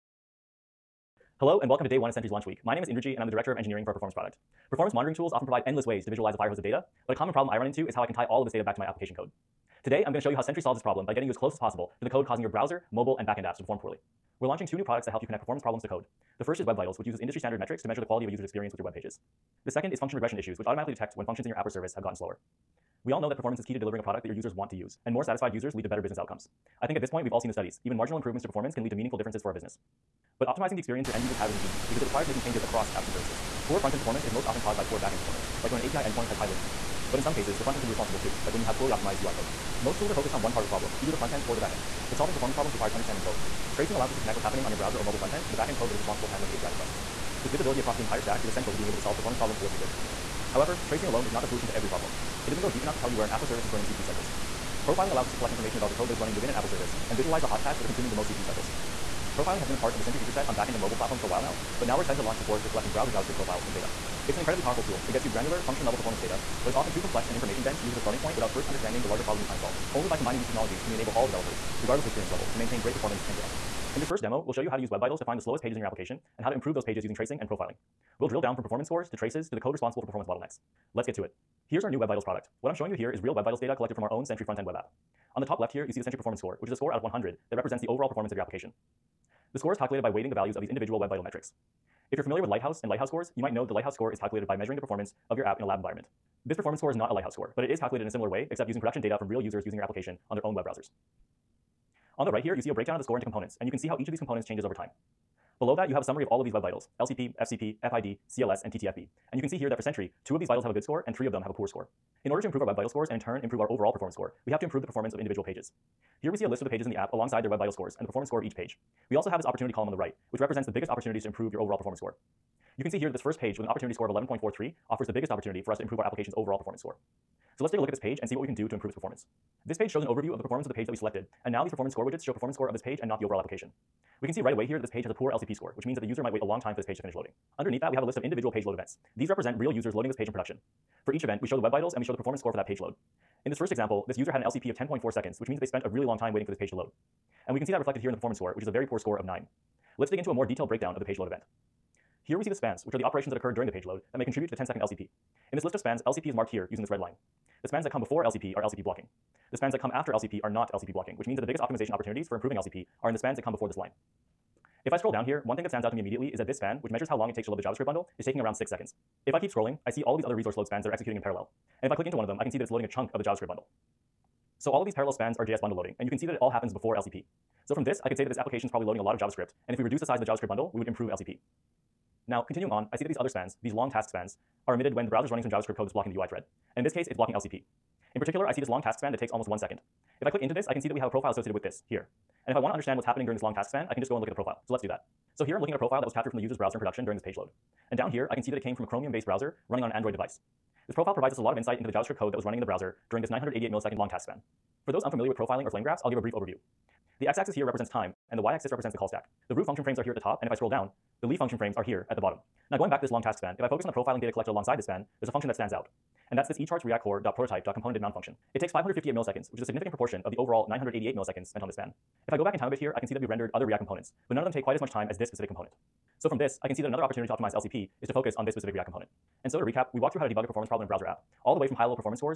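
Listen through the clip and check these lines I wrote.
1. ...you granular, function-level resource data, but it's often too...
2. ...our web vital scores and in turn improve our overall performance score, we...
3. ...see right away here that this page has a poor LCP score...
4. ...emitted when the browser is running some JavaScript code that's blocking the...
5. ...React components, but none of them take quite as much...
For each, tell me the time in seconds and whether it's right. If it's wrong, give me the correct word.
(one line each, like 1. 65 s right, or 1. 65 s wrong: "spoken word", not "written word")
1. 65 s wrong: "performance", not "resource"
2. 112 s right
3. 134 s right
4. 184 s right
5. 223 s right.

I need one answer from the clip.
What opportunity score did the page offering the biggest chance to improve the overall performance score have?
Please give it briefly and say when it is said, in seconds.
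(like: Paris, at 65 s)
11.43, at 124 s.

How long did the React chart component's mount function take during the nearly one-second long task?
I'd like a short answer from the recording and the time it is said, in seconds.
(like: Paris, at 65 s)
558 milliseconds, at 218 s.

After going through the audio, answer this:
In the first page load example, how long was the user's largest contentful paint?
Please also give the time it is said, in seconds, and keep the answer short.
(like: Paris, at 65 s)
10.4 seconds, at 144 s.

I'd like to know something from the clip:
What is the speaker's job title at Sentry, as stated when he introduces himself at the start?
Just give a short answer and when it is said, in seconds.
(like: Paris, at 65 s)
Director of Engineering, at 3 s.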